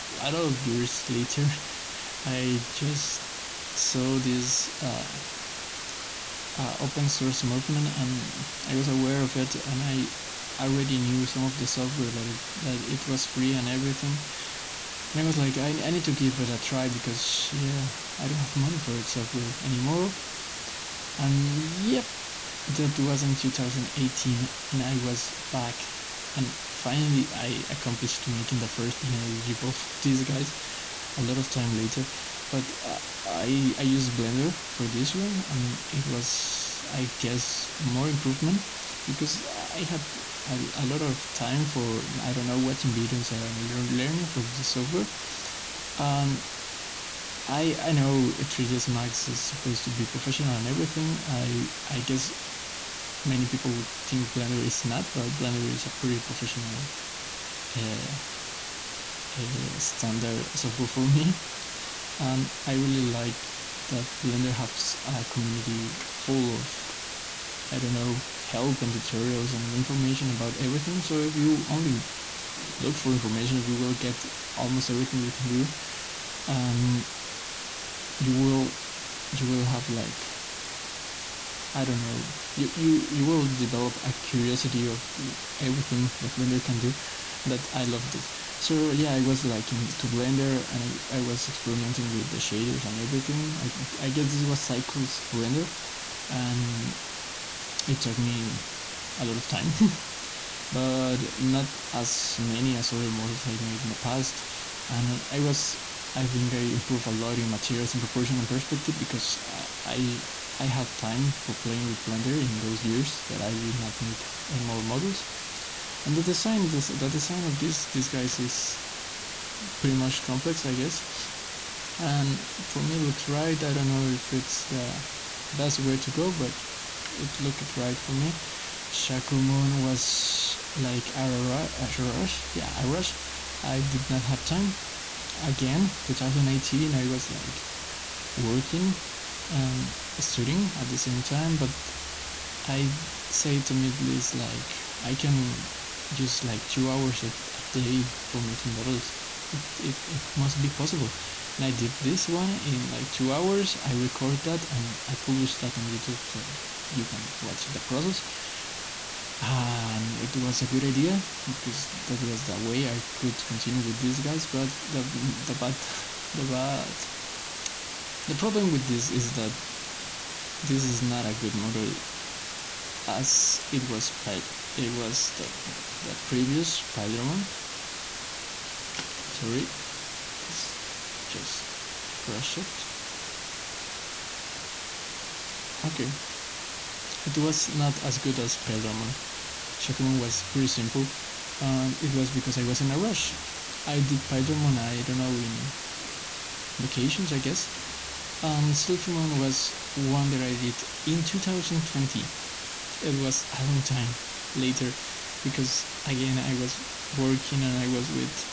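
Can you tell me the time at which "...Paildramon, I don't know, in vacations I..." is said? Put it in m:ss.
3:14.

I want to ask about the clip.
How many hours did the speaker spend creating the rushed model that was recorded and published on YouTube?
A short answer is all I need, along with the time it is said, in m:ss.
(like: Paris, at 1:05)
2, at 2:32.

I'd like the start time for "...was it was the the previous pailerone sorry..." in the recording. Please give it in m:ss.
2:53.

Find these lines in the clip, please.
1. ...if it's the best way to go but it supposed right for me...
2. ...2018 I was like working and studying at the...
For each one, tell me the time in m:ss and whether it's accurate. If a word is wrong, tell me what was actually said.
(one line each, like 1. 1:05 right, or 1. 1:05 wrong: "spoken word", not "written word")
1. 2:04 wrong: "looked", not "supposed"
2. 2:16 right.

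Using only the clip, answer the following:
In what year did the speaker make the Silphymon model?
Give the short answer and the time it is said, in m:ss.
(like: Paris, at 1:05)
2020, at 3:21.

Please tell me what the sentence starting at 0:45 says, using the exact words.
Um, I I know 3ds Max is supposed to be professional and everything.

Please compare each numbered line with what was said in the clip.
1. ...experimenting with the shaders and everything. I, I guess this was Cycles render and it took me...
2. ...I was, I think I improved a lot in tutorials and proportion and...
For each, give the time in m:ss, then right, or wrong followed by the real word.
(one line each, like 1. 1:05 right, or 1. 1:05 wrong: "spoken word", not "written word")
1. 1:31 right
2. 1:45 wrong: "materials", not "tutorials".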